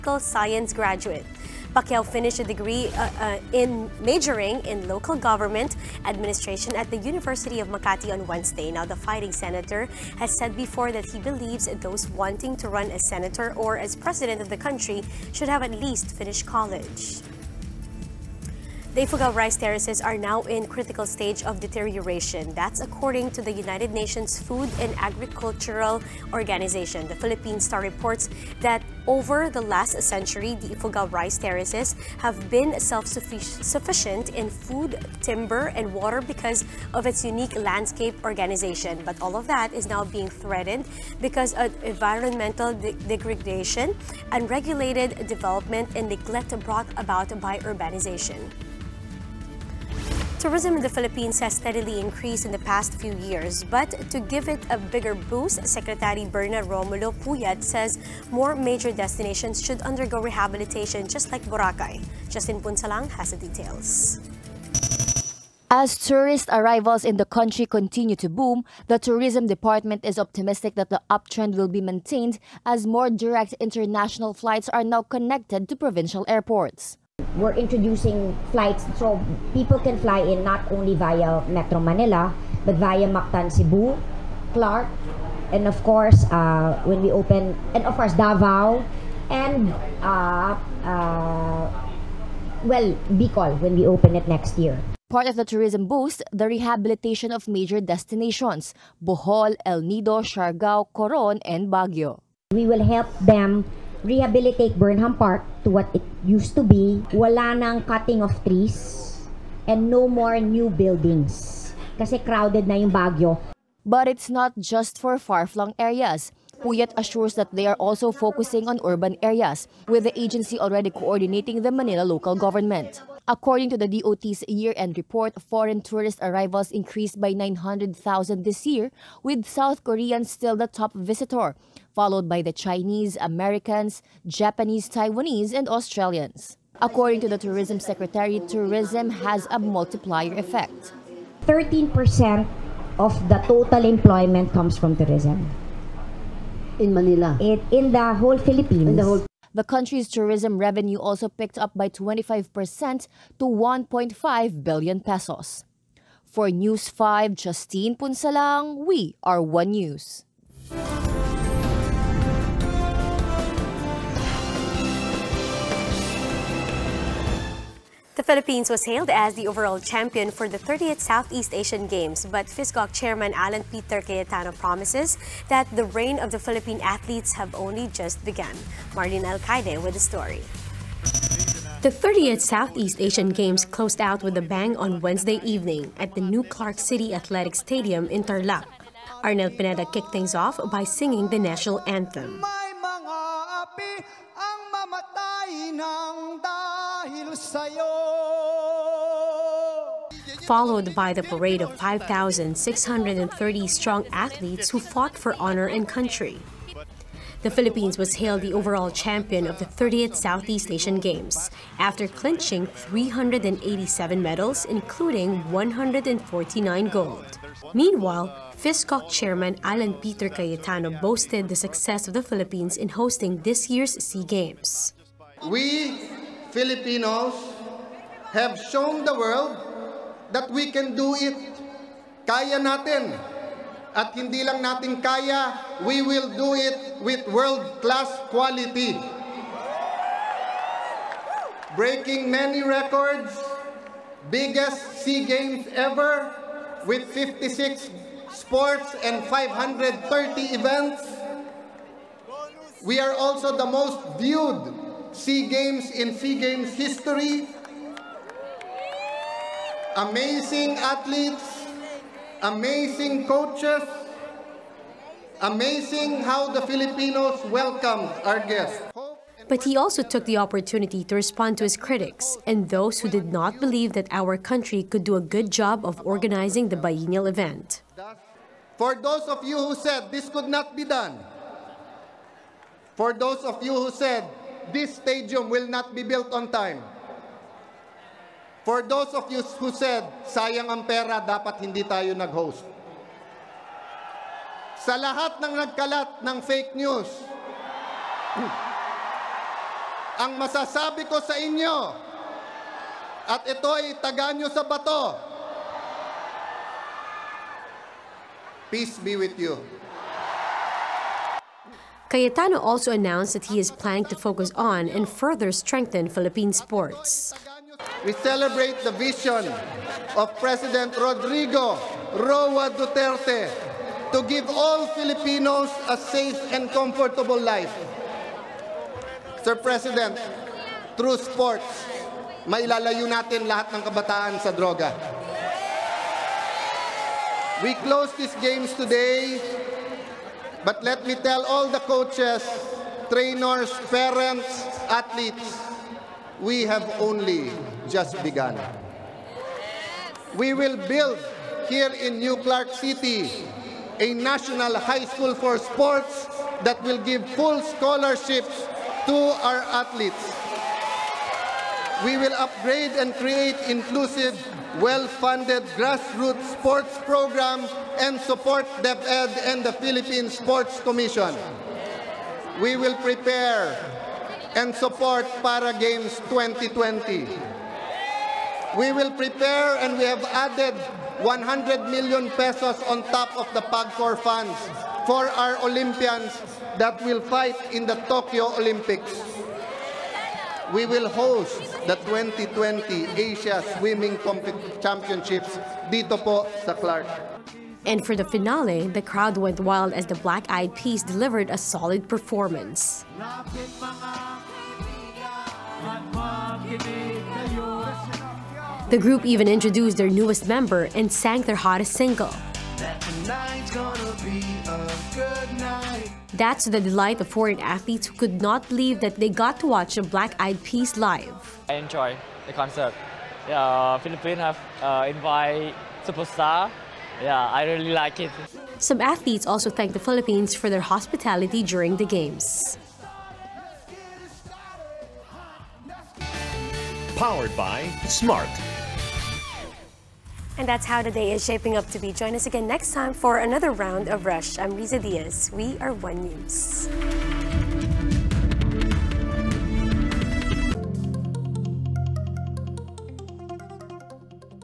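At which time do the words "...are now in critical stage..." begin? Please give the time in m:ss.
0:20.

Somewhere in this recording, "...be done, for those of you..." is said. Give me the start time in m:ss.
4:40.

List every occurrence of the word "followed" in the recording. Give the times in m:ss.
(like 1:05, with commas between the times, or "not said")
2:11, 3:20.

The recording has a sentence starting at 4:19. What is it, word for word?
Amazing athletes, amazing coaches, amazing how the Filipinos welcomed our guests.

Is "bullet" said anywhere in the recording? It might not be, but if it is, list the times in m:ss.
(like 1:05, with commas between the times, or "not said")
not said.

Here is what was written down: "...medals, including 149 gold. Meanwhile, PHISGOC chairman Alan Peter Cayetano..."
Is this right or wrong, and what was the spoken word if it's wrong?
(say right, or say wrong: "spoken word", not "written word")
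right.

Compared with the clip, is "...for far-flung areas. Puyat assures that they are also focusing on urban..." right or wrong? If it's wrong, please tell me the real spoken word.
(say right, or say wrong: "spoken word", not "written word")
right.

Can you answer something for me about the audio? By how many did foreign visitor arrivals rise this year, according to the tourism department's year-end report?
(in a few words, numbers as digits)
900,000.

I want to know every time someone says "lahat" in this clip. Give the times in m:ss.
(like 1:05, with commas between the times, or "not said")
4:55, 5:33.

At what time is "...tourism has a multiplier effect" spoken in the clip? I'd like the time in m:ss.
2:18.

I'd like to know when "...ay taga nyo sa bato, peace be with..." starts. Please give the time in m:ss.
5:03.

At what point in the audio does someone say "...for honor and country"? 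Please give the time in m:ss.
3:25.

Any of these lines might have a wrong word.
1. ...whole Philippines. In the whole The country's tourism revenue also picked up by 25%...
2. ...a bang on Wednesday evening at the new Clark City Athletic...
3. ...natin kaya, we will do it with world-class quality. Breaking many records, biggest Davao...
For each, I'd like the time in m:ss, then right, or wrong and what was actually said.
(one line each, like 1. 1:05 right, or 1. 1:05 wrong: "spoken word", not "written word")
1. 2:28 right
2. 3:04 right
3. 3:54 wrong: "SEA", not "Davao".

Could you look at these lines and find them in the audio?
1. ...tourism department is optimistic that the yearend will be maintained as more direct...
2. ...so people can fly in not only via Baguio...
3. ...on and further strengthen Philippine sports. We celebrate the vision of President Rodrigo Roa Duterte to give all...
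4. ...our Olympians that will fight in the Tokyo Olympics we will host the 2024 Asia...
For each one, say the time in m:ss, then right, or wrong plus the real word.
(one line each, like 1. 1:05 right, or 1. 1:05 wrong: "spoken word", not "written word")
1. 1:08 wrong: "uptrend", not "yearend"
2. 1:18 wrong: "Metro", not "Baguio"
3. 5:14 right
4. 6:25 wrong: "2020", not "2024".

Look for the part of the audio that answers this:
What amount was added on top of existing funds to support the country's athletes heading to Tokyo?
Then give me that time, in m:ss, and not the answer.
6:21.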